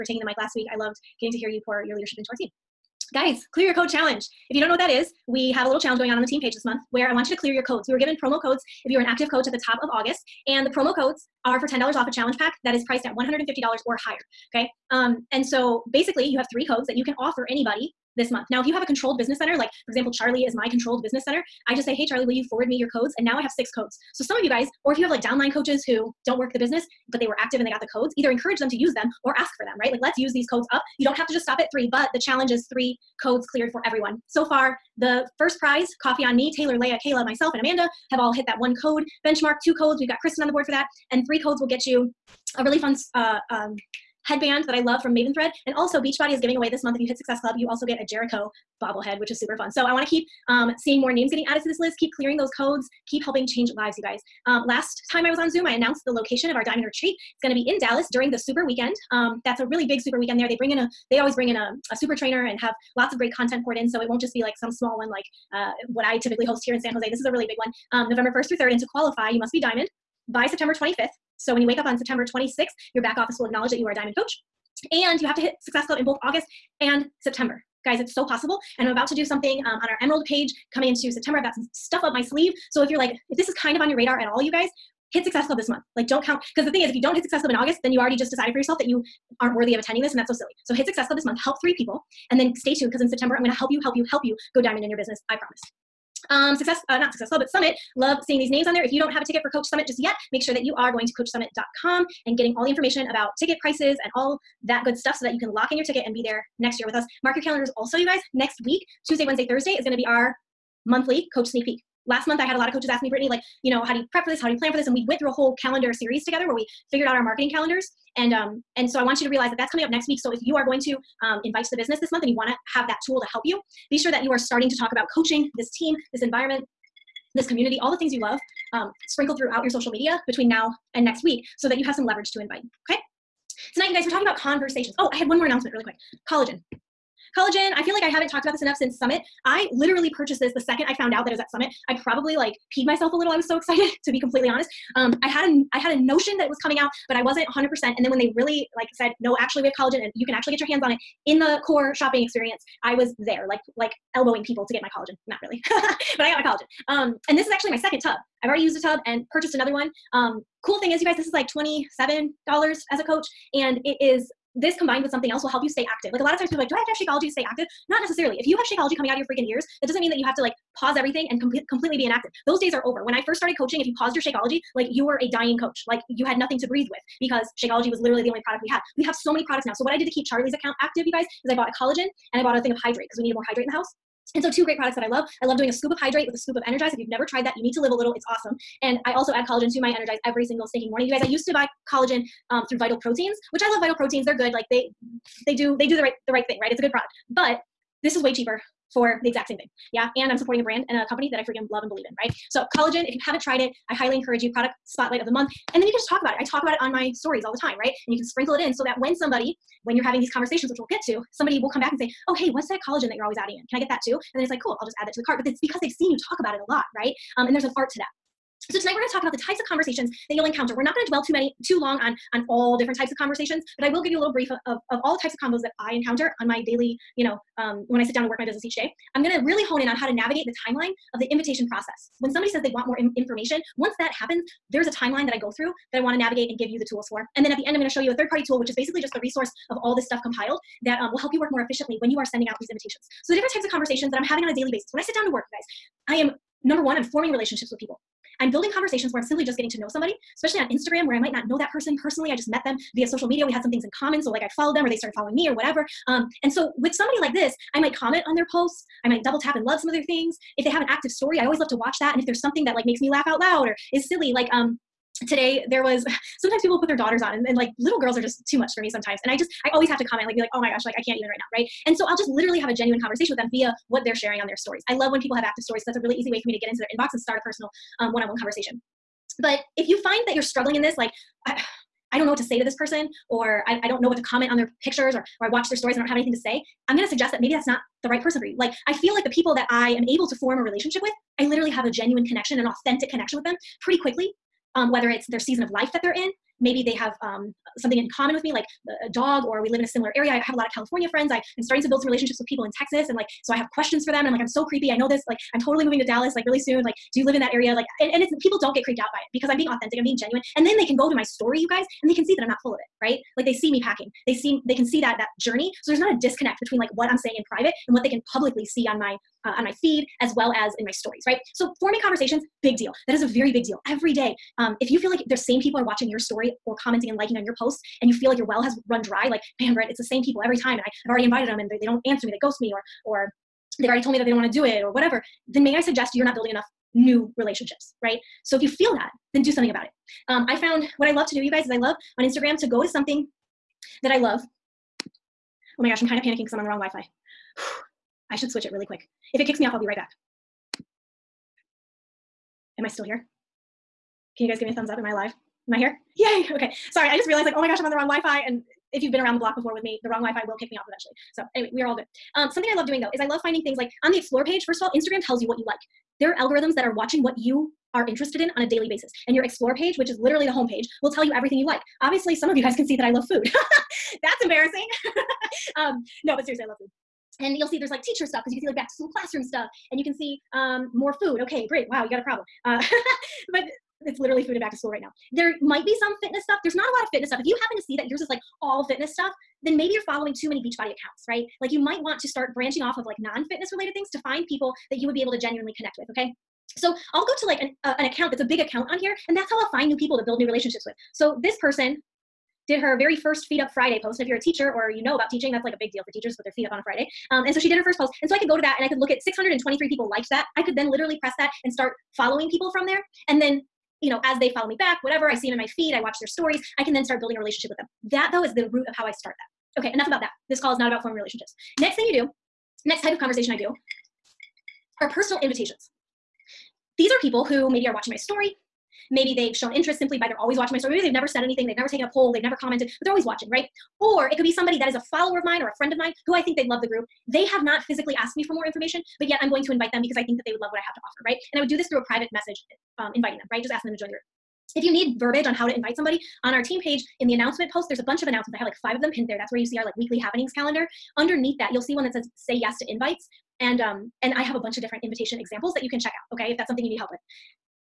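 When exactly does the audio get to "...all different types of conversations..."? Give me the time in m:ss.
3:42.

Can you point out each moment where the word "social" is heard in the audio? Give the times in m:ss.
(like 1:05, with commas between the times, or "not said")
2:09, 4:13.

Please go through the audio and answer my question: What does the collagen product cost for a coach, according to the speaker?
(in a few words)
$27.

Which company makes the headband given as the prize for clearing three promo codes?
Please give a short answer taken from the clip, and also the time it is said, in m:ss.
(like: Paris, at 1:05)
Maven Thread, at 0:45.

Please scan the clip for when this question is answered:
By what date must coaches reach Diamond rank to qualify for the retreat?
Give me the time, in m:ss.
1:10.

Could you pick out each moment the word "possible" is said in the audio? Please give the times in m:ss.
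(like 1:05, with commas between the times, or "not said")
1:18.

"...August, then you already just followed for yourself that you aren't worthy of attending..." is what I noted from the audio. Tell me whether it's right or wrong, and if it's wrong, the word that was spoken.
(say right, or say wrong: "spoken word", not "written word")
wrong: "decided", not "followed".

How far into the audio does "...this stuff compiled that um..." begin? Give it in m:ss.
3:59.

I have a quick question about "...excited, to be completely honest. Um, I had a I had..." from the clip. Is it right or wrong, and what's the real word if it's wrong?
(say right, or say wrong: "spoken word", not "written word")
right.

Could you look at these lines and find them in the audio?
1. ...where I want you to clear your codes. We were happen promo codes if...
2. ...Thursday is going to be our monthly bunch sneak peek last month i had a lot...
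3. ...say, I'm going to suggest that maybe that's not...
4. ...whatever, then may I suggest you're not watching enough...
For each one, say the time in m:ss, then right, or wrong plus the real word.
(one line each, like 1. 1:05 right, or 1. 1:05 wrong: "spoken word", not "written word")
1. 0:06 wrong: "given", not "happen"
2. 1:49 wrong: "coach", not "bunch"
3. 4:46 right
4. 5:34 wrong: "building", not "watching".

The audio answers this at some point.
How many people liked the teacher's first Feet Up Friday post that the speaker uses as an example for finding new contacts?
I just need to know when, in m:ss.
6:49.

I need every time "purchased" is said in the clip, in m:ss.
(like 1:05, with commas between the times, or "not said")
2:20, 2:39.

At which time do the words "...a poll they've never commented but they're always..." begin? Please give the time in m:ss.
7:12.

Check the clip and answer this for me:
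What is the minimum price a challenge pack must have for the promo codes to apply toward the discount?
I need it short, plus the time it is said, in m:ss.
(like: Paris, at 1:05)
$150, at 0:13.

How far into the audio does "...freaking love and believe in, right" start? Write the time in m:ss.
3:21.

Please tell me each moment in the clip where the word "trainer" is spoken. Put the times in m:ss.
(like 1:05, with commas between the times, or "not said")
1:02.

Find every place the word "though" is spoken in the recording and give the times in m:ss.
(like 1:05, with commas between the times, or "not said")
6:02, 6:58.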